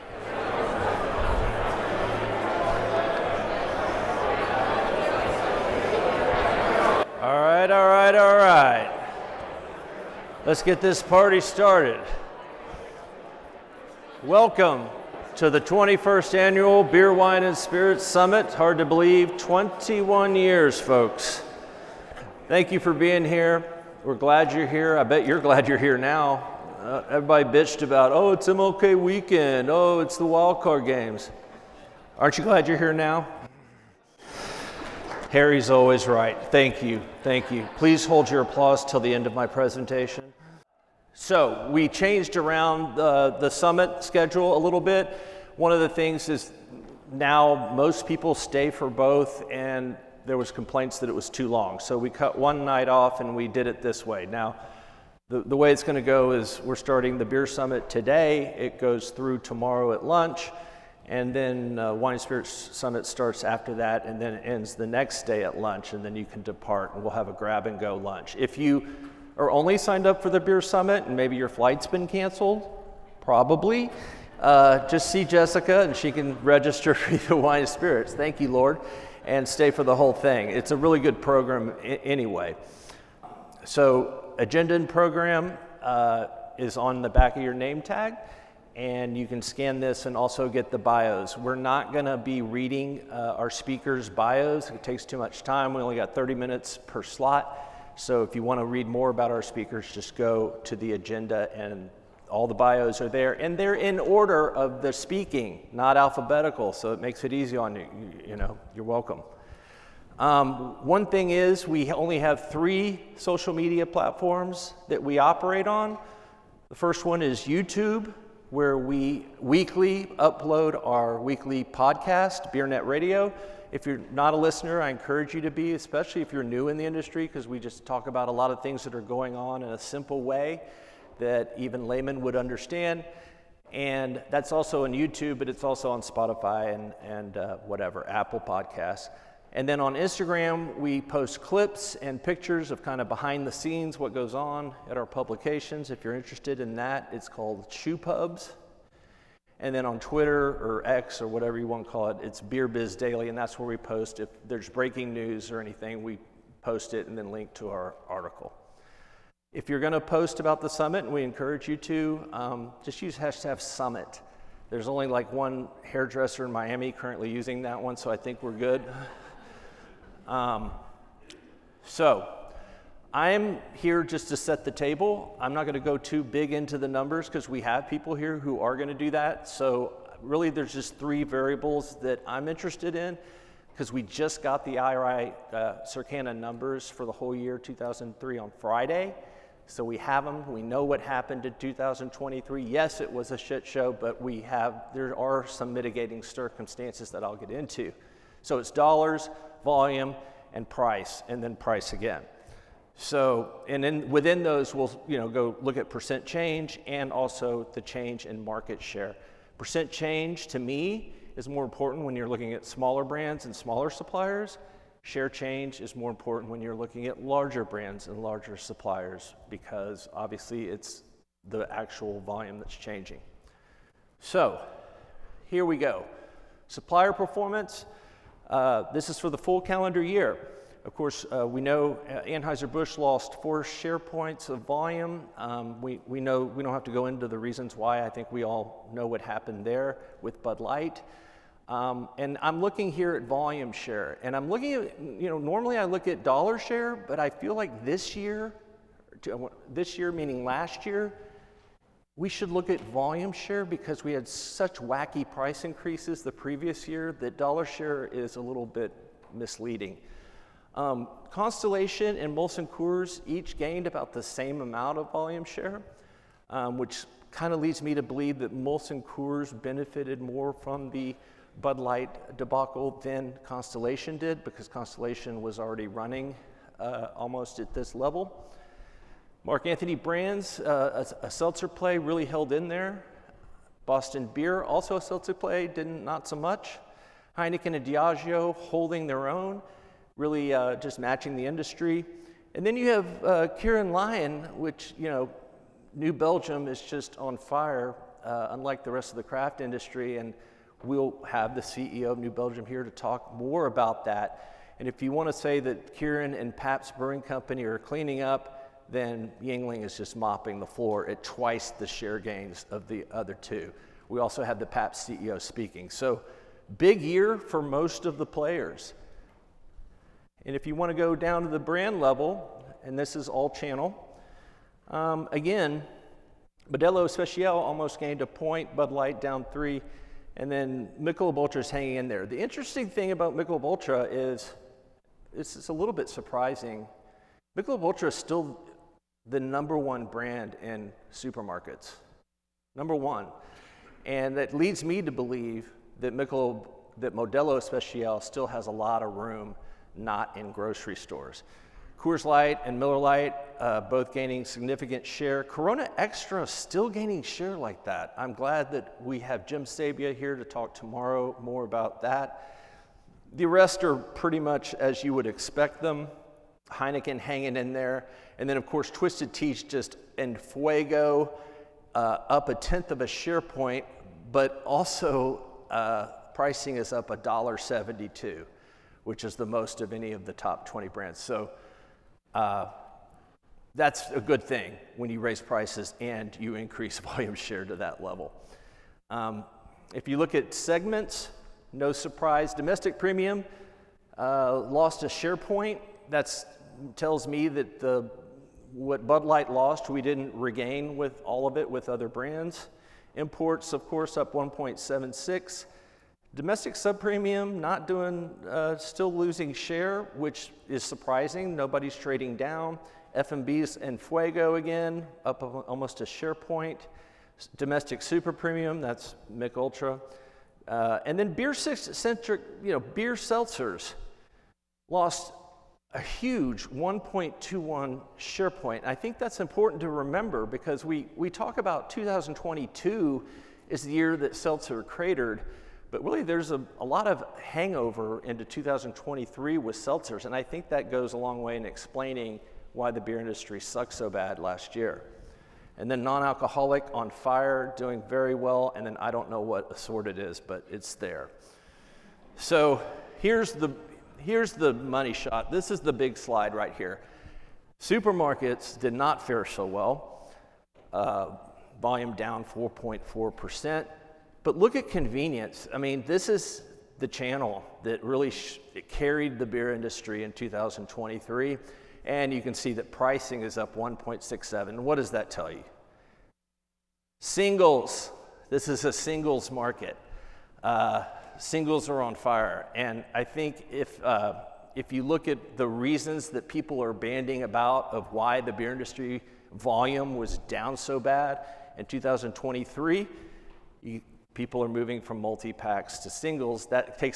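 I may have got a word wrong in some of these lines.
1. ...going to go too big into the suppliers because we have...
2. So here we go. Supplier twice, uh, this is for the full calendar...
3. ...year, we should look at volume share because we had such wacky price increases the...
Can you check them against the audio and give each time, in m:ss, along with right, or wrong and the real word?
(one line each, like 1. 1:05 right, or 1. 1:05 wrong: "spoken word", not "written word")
1. 2:55 wrong: "numbers", not "suppliers"
2. 3:44 wrong: "performance", not "twice"
3. 4:10 right.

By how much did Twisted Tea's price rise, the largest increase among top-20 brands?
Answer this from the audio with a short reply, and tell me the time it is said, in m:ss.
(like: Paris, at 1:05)
$1.72, at 6:17.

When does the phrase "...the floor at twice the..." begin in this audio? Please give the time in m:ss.
5:10.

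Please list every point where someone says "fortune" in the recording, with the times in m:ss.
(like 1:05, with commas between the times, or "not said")
not said.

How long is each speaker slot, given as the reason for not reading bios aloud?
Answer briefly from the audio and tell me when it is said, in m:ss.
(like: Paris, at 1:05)
30, at 1:36.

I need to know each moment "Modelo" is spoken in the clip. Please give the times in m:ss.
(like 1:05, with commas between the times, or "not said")
5:26, 5:47.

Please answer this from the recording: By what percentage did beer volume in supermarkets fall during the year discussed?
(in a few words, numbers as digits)
4.4%.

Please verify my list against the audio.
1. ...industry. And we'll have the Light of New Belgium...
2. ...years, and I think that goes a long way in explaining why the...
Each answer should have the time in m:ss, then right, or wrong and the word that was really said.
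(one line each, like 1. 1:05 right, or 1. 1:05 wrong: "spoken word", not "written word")
1. 4:59 wrong: "CEO", not "Light"
2. 7:19 wrong: "seltzers", not "years".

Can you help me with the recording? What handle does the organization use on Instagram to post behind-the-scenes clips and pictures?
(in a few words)
Chew Pubs.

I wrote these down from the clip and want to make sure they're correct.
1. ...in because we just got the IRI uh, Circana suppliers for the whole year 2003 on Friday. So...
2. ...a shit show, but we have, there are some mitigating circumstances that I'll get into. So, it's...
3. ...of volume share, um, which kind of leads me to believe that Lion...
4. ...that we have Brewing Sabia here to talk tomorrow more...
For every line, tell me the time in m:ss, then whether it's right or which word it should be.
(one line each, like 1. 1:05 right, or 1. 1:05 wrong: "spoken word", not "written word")
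1. 3:02 wrong: "numbers", not "suppliers"
2. 3:13 right
3. 4:24 wrong: "Molson", not "Lion"
4. 5:58 wrong: "Jim", not "Brewing".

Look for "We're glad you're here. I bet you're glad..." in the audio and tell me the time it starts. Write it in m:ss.
0:24.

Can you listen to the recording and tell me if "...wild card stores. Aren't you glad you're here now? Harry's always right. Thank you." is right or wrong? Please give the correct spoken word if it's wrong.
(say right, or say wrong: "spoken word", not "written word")
wrong: "games", not "stores".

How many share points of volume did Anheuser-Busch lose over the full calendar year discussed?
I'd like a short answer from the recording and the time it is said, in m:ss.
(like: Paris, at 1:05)
4, at 3:53.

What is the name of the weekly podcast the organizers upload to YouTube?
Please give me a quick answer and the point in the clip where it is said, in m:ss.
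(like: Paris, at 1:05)
BeerNet Radio, at 2:02.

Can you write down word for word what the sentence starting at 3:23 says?
So, and then within those, we'll you know, go look at percent change and also the change in market share.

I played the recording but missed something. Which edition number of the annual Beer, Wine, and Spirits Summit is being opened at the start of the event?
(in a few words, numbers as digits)
21st.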